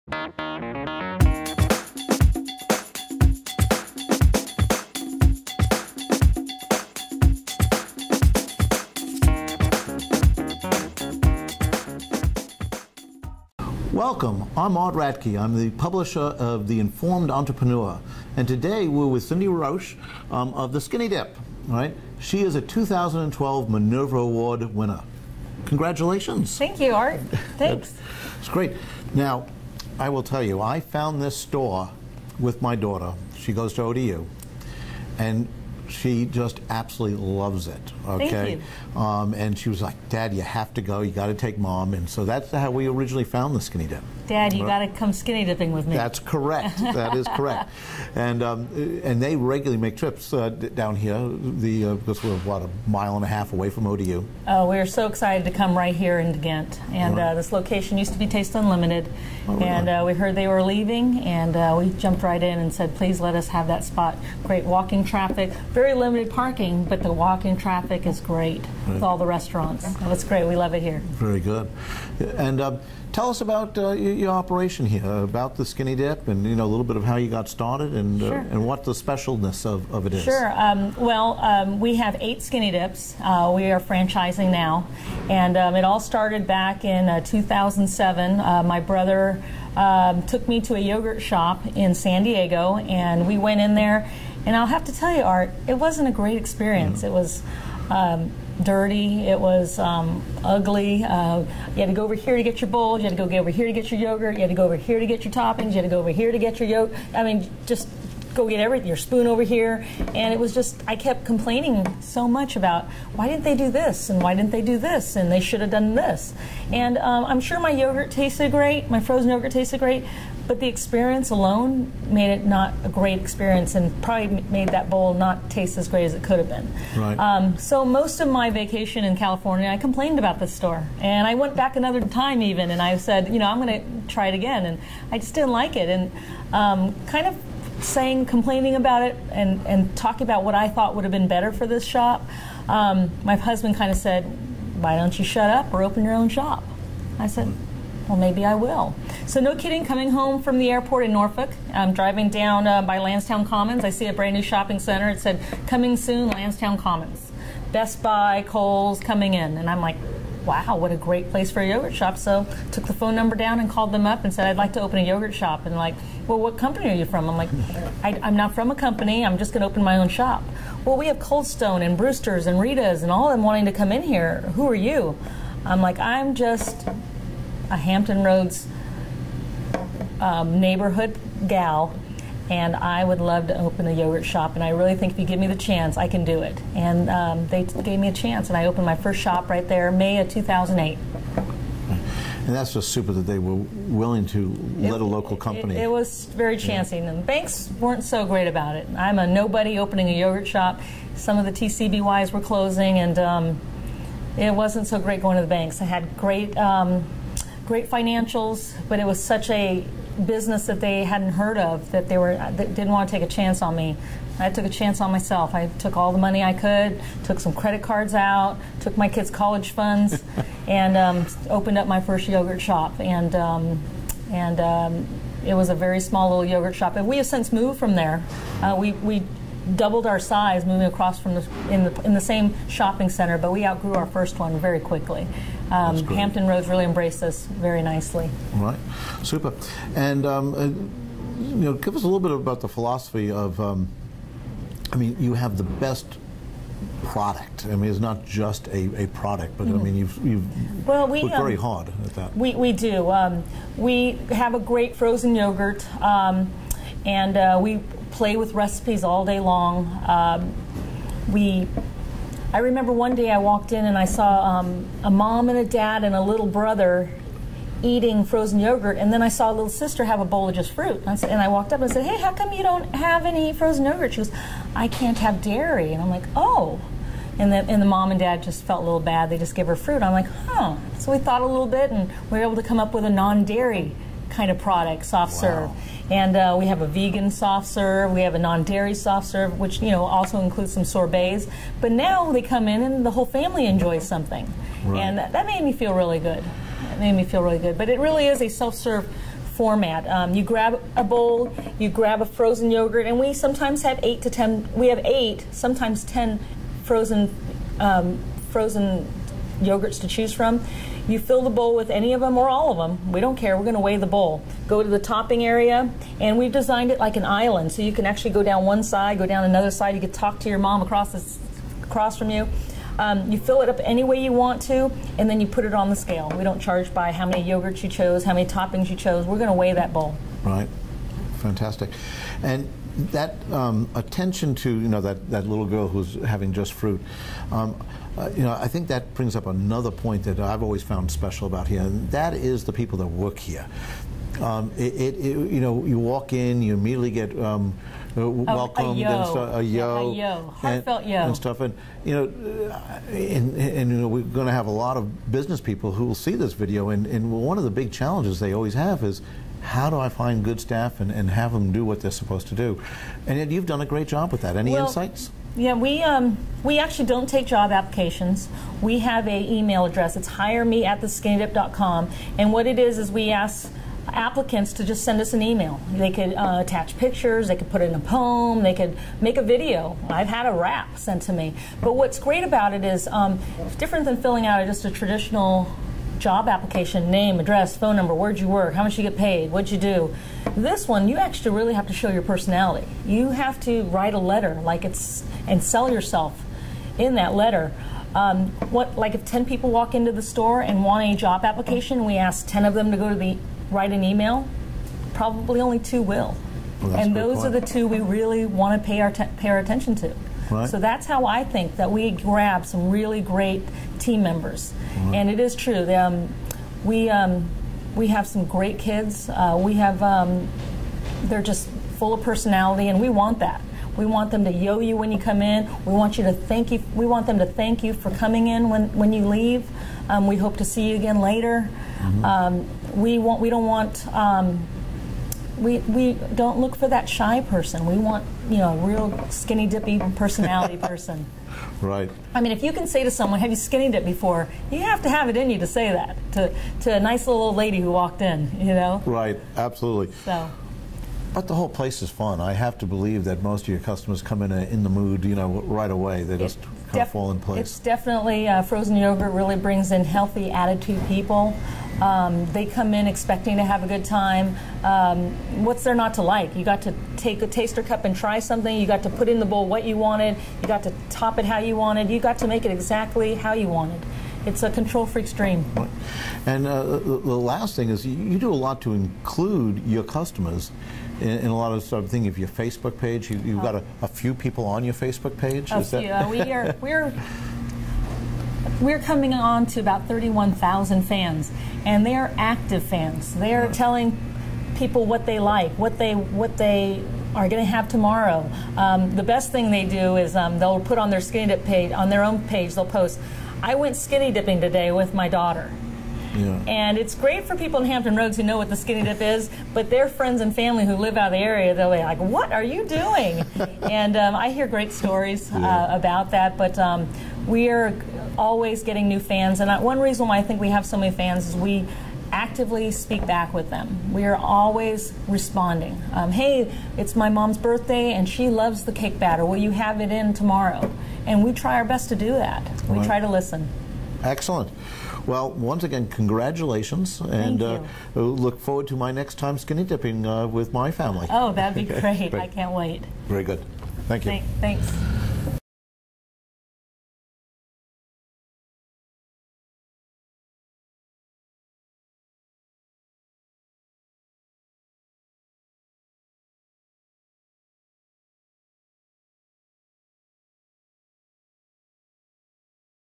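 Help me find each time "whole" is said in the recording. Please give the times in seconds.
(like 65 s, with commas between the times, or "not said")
293 s, 451 s.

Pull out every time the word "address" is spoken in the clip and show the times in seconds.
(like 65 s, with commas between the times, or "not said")
369 s, 387 s.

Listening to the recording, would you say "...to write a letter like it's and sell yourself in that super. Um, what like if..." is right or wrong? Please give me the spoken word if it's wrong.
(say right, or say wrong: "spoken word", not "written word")
wrong: "letter", not "super".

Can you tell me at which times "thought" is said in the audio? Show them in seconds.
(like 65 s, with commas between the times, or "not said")
140 s, 281 s.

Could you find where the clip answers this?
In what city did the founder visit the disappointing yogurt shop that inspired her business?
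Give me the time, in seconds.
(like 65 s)
91 s.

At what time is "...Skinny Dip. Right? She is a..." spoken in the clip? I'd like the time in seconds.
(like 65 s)
20 s.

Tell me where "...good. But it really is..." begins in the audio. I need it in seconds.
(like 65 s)
297 s.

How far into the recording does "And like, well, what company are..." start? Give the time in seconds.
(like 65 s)
165 s.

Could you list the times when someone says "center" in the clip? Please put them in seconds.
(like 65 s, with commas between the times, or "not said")
154 s, 233 s.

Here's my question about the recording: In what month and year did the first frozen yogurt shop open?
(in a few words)
May 2008.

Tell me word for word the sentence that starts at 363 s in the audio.
And yet you've done a great job with that.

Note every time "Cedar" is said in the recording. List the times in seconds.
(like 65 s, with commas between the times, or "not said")
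not said.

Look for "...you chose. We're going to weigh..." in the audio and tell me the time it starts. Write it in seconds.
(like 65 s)
328 s.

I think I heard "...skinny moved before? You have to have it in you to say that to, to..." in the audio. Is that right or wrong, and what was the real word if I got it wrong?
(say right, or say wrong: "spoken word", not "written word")
wrong: "dipped", not "moved".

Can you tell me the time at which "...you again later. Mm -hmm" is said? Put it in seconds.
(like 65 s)
430 s.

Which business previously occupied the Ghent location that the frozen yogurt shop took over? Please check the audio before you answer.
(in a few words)
Taste Unlimited.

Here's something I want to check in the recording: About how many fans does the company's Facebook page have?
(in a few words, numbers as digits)
31,000.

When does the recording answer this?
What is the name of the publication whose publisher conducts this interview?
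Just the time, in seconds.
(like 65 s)
16 s.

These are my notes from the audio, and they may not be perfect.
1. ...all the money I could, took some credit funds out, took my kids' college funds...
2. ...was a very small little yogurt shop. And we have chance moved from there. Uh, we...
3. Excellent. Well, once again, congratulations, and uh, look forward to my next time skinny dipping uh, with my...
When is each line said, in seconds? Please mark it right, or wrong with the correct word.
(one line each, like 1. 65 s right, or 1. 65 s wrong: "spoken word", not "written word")
1. 215 s wrong: "cards", not "funds"
2. 225 s wrong: "since", not "chance"
3. 534 s right.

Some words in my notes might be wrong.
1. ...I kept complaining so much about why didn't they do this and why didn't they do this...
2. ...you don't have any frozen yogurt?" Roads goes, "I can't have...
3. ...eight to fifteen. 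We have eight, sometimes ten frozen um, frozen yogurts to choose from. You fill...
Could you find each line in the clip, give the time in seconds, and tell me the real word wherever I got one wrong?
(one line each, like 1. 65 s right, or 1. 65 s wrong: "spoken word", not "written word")
1. 110 s right
2. 272 s wrong: "She", not "Roads"
3. 304 s wrong: "ten", not "fifteen".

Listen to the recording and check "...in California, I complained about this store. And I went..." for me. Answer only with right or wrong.
right.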